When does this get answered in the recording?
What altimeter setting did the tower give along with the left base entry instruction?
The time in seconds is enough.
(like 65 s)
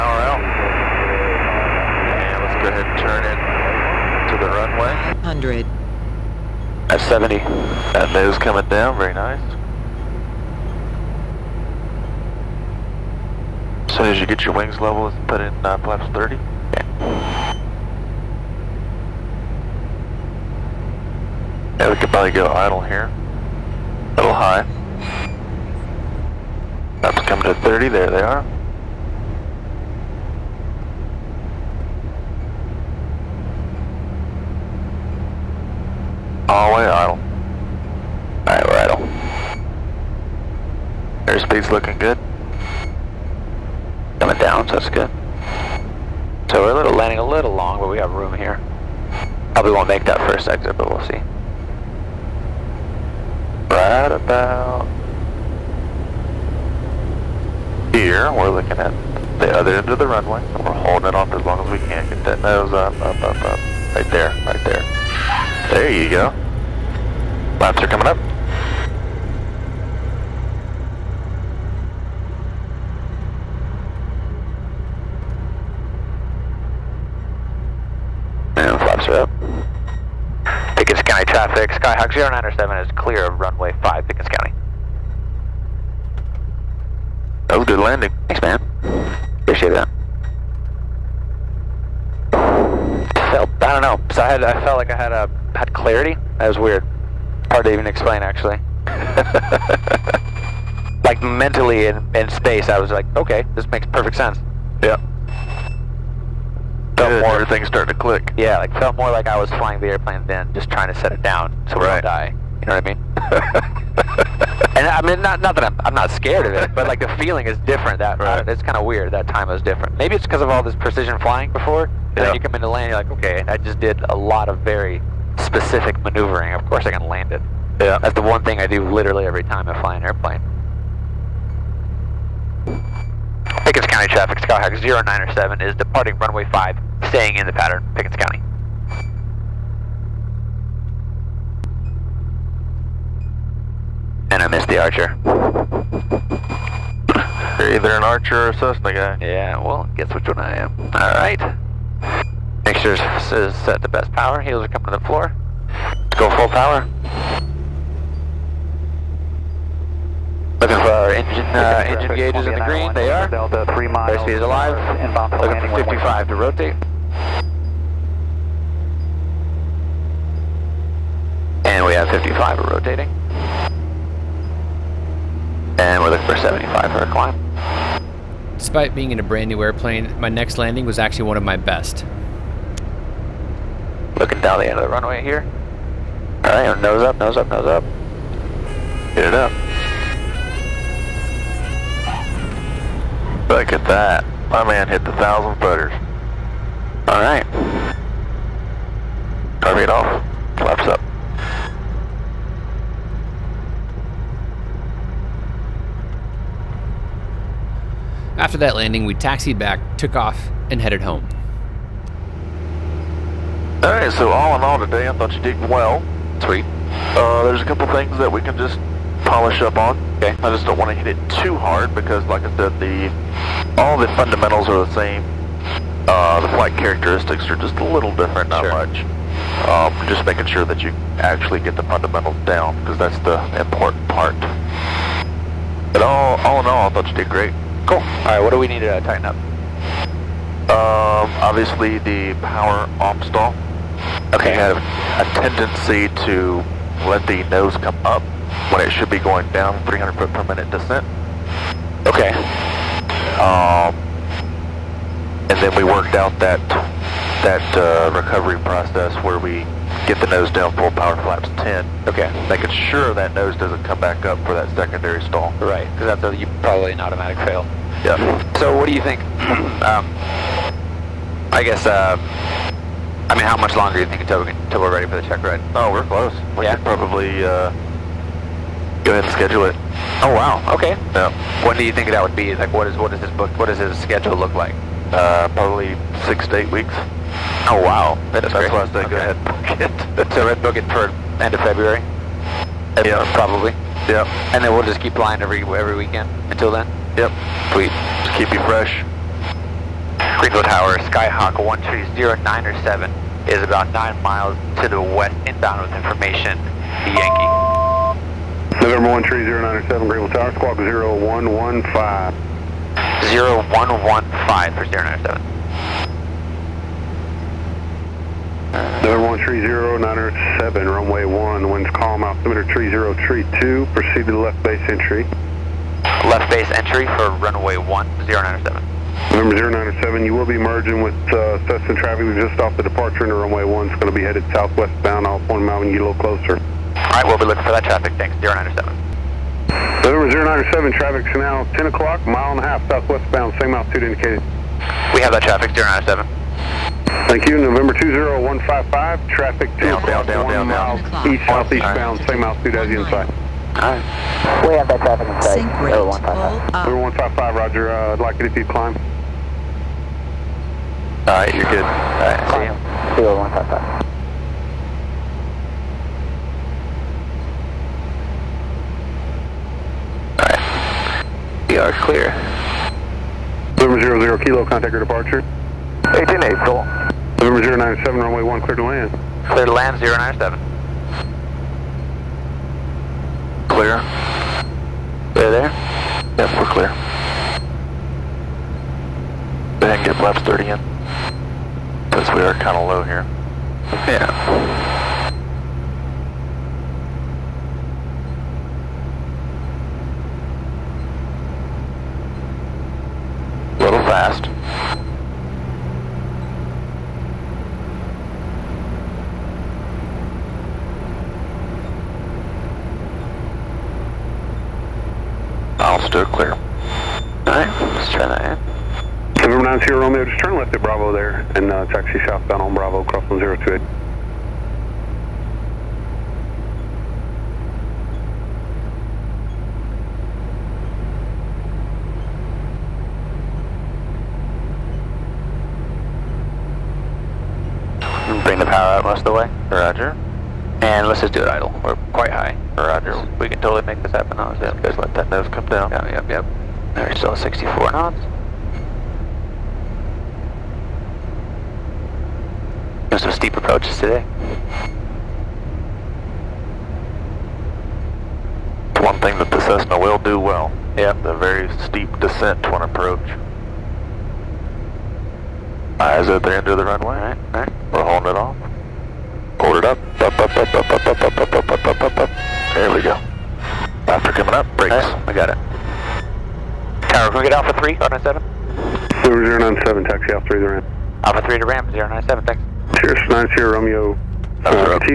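322 s.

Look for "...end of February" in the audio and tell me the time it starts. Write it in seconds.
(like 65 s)
291 s.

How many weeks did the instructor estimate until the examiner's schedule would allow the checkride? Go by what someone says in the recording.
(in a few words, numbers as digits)
6 to 8 weeks.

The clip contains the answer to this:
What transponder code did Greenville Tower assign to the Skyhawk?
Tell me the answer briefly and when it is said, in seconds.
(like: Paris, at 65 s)
0115, at 310 s.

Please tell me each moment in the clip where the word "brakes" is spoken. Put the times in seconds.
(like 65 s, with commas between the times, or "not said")
474 s.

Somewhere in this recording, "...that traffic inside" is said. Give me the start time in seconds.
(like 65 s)
354 s.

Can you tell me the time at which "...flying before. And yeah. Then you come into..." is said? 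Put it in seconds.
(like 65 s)
121 s.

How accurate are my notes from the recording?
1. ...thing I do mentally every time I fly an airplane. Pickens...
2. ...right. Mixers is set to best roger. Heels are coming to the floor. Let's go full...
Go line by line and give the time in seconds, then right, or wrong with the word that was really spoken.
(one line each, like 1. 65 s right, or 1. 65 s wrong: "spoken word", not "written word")
1. 128 s wrong: "literally", not "mentally"
2. 151 s wrong: "power", not "roger".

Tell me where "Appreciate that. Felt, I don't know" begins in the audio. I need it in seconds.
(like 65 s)
89 s.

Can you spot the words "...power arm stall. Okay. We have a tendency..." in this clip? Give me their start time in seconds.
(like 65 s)
242 s.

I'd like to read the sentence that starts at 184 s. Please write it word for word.
Looking down the end of the runway here.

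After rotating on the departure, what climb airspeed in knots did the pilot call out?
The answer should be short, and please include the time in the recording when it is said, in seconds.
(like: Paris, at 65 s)
75, at 176 s.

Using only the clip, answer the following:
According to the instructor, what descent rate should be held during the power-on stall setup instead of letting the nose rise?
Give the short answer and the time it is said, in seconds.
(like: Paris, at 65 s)
300 feet per minute, at 249 s.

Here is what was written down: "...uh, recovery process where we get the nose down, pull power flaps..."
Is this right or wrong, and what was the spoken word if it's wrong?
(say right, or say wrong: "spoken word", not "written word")
right.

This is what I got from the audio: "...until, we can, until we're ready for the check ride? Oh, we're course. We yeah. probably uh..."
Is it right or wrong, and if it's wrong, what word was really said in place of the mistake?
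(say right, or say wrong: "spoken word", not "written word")
wrong: "close", not "course".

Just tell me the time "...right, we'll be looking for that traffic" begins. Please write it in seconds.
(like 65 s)
336 s.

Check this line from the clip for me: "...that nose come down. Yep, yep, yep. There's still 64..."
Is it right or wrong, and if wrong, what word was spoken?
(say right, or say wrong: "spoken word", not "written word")
right.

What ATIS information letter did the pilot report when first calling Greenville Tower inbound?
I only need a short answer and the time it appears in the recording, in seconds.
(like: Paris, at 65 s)
Yankee, at 307 s.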